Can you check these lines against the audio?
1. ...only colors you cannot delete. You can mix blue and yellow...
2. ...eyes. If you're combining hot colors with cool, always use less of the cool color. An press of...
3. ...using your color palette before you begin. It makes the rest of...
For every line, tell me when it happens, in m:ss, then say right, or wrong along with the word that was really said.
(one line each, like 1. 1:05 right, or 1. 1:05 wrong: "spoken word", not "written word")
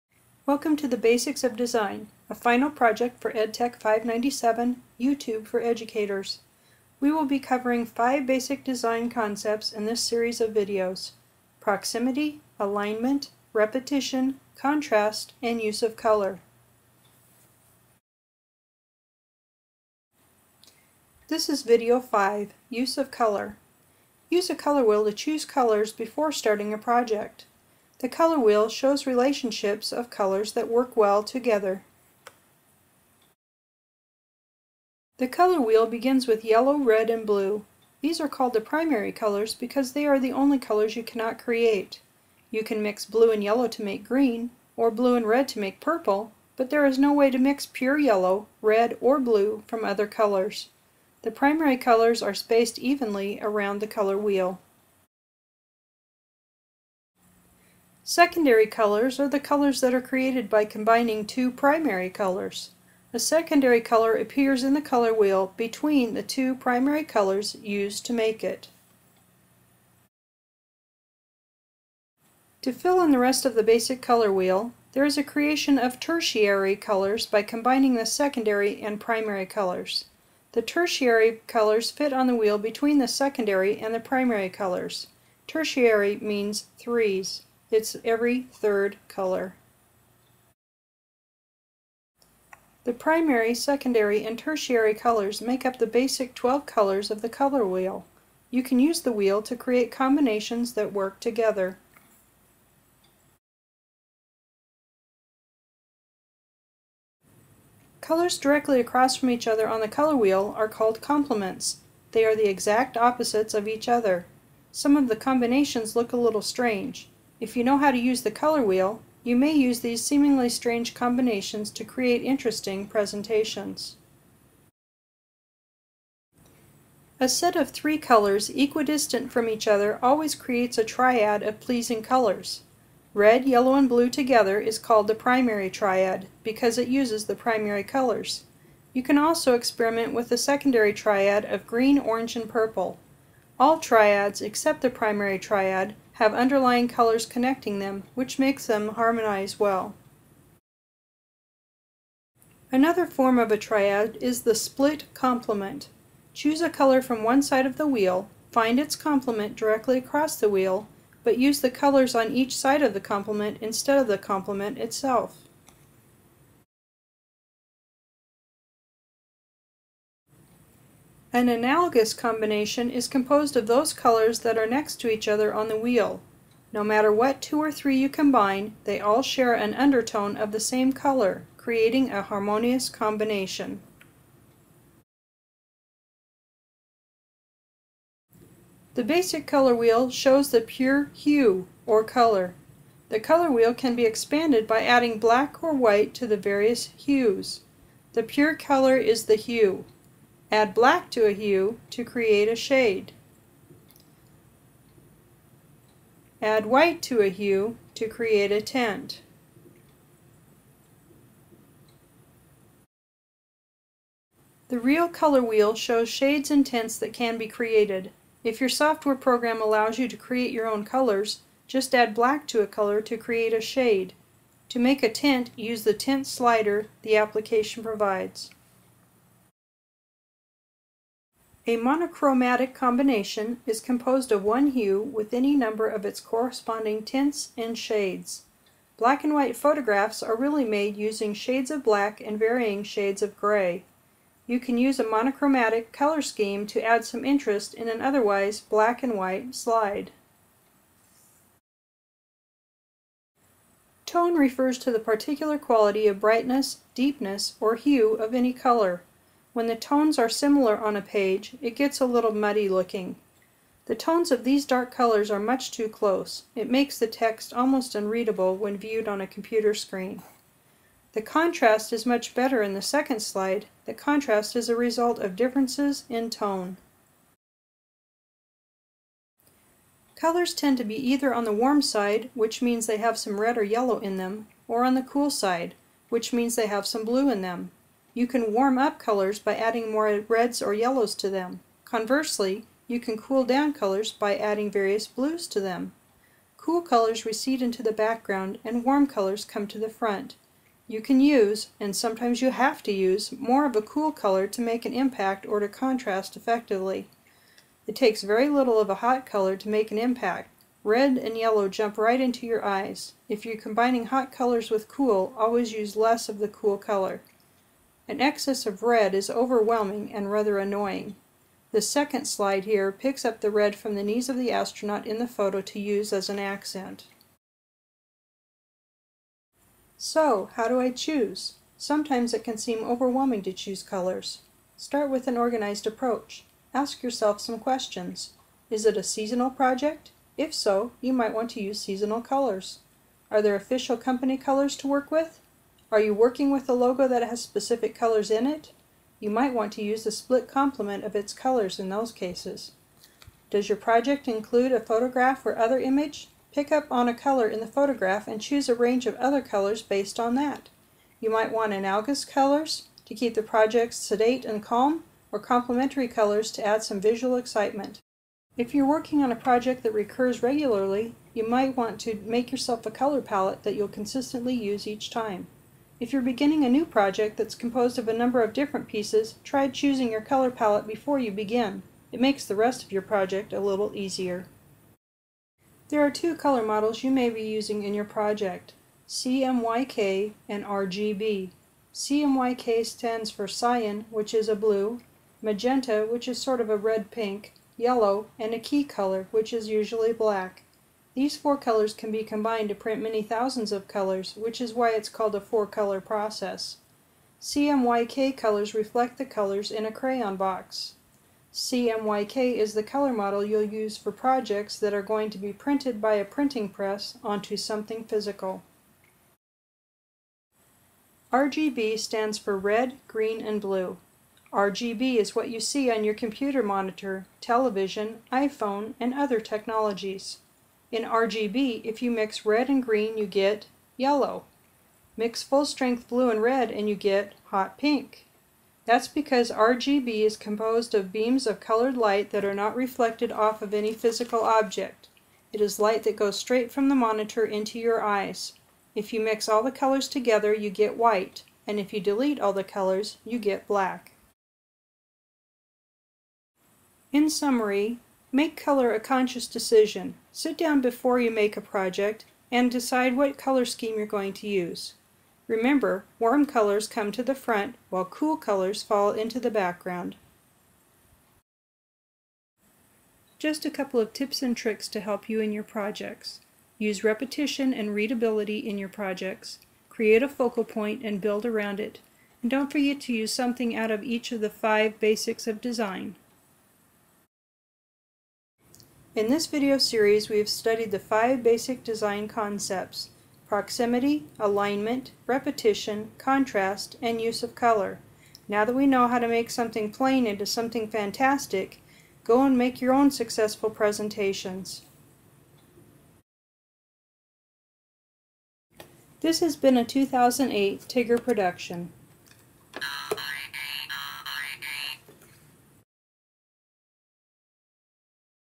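1. 0:40 wrong: "create", not "delete"
2. 5:12 wrong: "excess", not "press"
3. 6:19 wrong: "choosing", not "using".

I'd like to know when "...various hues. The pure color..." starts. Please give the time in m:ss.
3:16.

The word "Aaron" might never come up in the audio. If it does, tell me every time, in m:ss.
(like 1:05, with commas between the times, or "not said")
not said.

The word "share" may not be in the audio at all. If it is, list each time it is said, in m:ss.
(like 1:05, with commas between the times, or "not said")
2:59.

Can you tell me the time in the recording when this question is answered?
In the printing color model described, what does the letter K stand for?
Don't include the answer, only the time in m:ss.
6:38.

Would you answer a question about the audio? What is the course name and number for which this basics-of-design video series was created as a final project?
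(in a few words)
EdTech 597.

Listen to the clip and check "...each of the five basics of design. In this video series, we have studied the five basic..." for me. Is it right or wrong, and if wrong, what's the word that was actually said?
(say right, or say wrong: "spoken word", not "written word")
right.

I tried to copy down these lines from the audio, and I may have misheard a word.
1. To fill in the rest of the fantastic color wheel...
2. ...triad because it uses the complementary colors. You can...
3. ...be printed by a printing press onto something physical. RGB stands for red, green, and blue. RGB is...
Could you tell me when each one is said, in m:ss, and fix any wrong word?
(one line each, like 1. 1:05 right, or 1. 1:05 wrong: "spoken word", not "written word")
1. 1:12 wrong: "basic", not "fantastic"
2. 2:15 wrong: "primary", not "complementary"
3. 6:55 right.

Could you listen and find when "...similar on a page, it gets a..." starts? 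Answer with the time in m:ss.
4:20.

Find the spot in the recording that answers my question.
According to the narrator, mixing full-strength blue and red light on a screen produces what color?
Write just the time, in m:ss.
7:17.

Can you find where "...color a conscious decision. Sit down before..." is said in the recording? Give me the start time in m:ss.
7:38.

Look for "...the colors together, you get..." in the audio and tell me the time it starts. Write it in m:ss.
7:29.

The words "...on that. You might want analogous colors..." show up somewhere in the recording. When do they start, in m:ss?
6:00.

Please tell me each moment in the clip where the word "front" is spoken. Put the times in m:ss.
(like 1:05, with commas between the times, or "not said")
4:59, 7:47.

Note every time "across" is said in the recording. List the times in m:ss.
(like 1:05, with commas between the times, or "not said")
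1:48, 2:39.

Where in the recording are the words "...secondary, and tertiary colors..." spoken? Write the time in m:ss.
1:33.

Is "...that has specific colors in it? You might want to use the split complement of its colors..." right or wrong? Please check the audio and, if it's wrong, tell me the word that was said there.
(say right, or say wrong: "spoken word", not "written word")
right.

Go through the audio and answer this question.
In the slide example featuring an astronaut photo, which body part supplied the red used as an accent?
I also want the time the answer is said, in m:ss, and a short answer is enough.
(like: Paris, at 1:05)
Knees, at 5:24.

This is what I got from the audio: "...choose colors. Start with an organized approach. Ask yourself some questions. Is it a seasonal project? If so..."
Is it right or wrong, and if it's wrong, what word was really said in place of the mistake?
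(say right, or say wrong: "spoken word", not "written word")
right.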